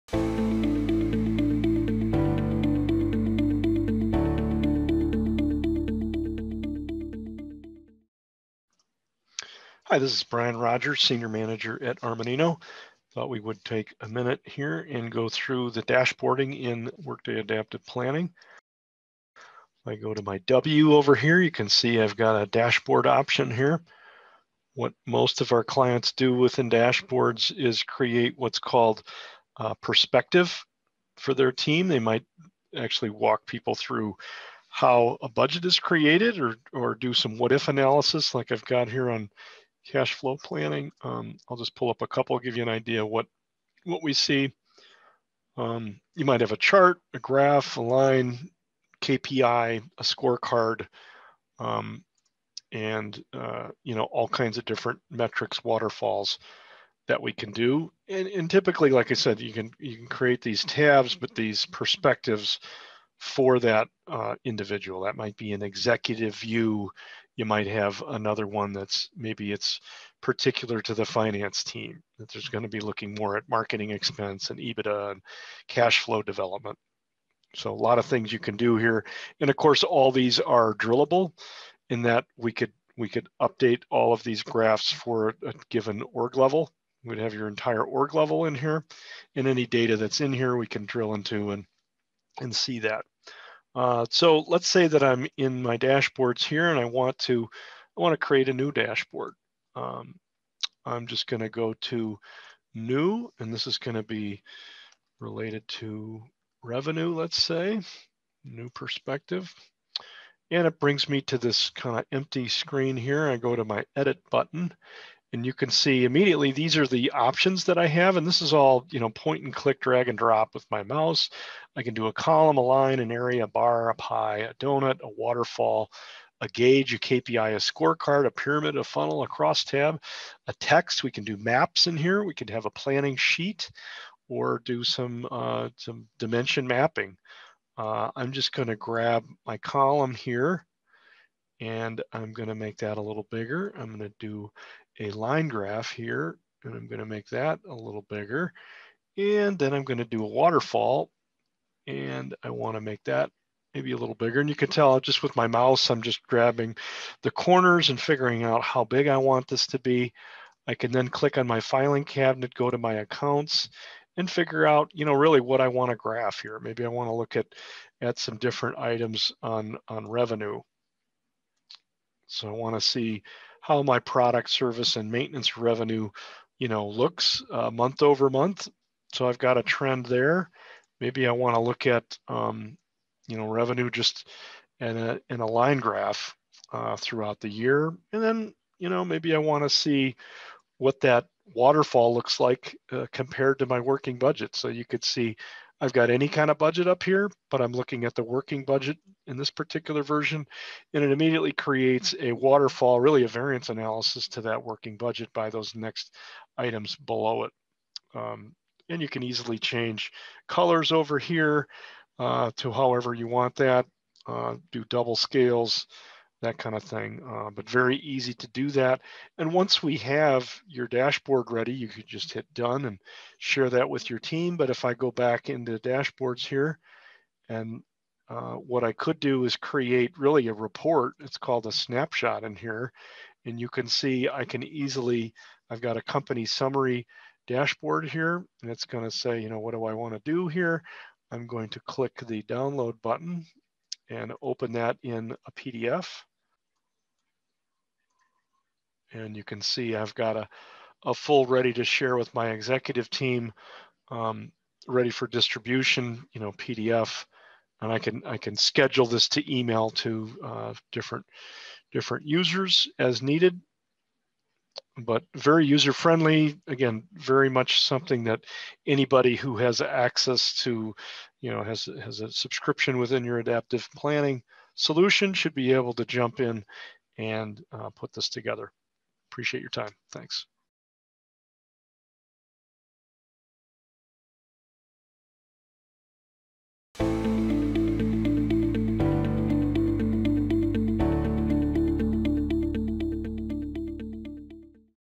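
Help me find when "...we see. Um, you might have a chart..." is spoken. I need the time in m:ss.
0:44.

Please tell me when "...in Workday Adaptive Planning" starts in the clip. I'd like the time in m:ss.
0:16.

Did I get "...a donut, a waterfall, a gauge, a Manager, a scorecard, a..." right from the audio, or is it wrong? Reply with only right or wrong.
wrong.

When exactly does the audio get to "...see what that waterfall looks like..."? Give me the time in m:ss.
3:09.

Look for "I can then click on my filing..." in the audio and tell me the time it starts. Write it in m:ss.
2:40.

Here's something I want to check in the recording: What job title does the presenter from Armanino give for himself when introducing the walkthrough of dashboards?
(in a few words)
Senior Manager.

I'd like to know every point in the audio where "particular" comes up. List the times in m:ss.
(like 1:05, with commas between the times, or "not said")
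1:10, 3:19.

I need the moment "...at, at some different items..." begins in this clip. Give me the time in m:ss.
2:47.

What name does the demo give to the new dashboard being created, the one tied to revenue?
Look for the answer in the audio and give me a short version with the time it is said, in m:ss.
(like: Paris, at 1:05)
new perspective, at 1:48.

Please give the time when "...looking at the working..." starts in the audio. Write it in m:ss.
3:17.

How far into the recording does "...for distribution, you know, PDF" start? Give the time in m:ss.
4:15.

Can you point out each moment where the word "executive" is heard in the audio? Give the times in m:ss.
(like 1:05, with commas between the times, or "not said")
1:05, 4:12.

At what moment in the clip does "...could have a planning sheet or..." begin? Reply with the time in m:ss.
2:12.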